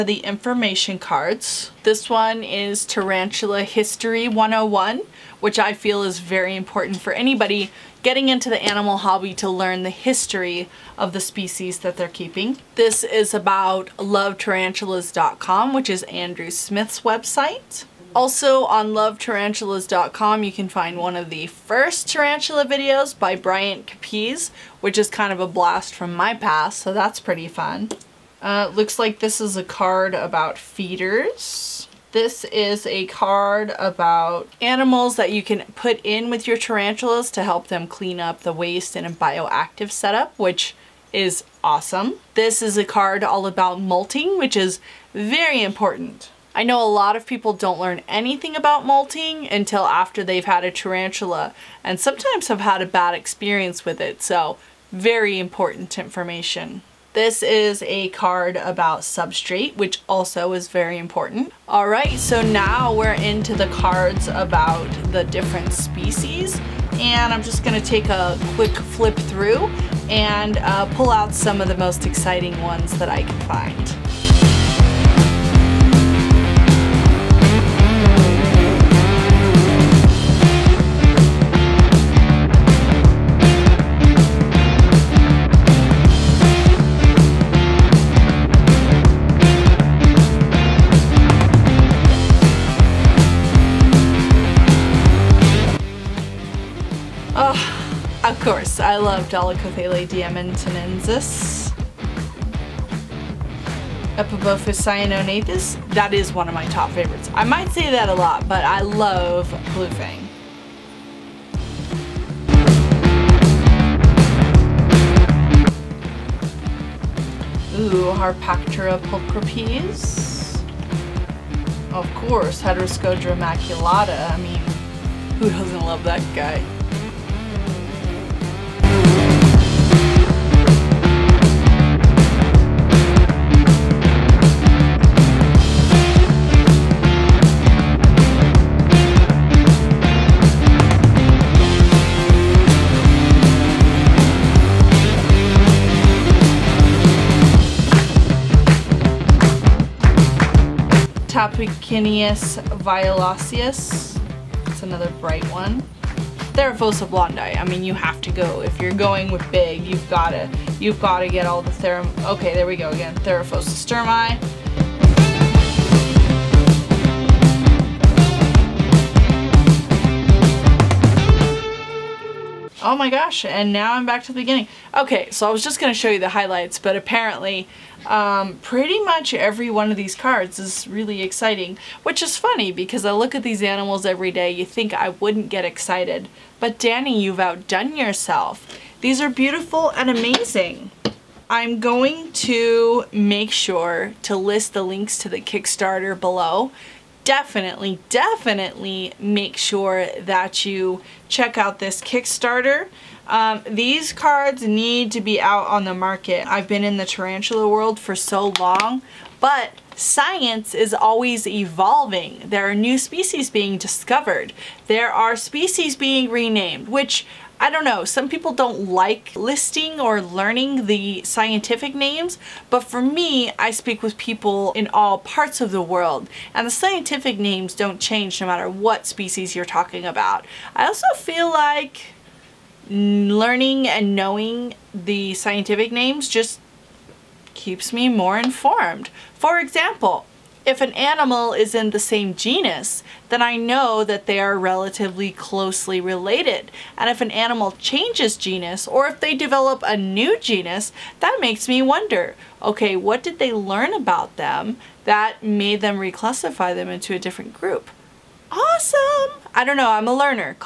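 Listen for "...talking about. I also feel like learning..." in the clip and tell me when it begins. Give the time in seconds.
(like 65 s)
229 s.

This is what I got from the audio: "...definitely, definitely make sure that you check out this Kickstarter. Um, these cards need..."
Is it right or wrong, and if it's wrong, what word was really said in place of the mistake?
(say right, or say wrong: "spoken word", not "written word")
right.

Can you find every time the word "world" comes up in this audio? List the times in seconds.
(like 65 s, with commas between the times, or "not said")
207 s, 225 s.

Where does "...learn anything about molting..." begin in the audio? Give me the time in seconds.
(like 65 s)
47 s.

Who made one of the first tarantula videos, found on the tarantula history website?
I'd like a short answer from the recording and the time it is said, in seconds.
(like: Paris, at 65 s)
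Bryant Capiz, at 23 s.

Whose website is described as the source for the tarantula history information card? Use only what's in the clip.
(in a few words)
Andrew Smith.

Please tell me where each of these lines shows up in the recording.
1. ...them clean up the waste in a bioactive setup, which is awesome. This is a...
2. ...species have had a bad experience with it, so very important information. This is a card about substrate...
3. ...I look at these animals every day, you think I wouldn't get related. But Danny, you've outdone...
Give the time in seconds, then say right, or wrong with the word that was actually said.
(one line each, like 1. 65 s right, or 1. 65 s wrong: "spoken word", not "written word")
1. 37 s right
2. 51 s wrong: "sometimes", not "species"
3. 183 s wrong: "excited", not "related".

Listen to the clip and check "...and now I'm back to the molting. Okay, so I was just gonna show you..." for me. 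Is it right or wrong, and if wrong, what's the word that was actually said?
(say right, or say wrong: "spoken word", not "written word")
wrong: "beginning", not "molting".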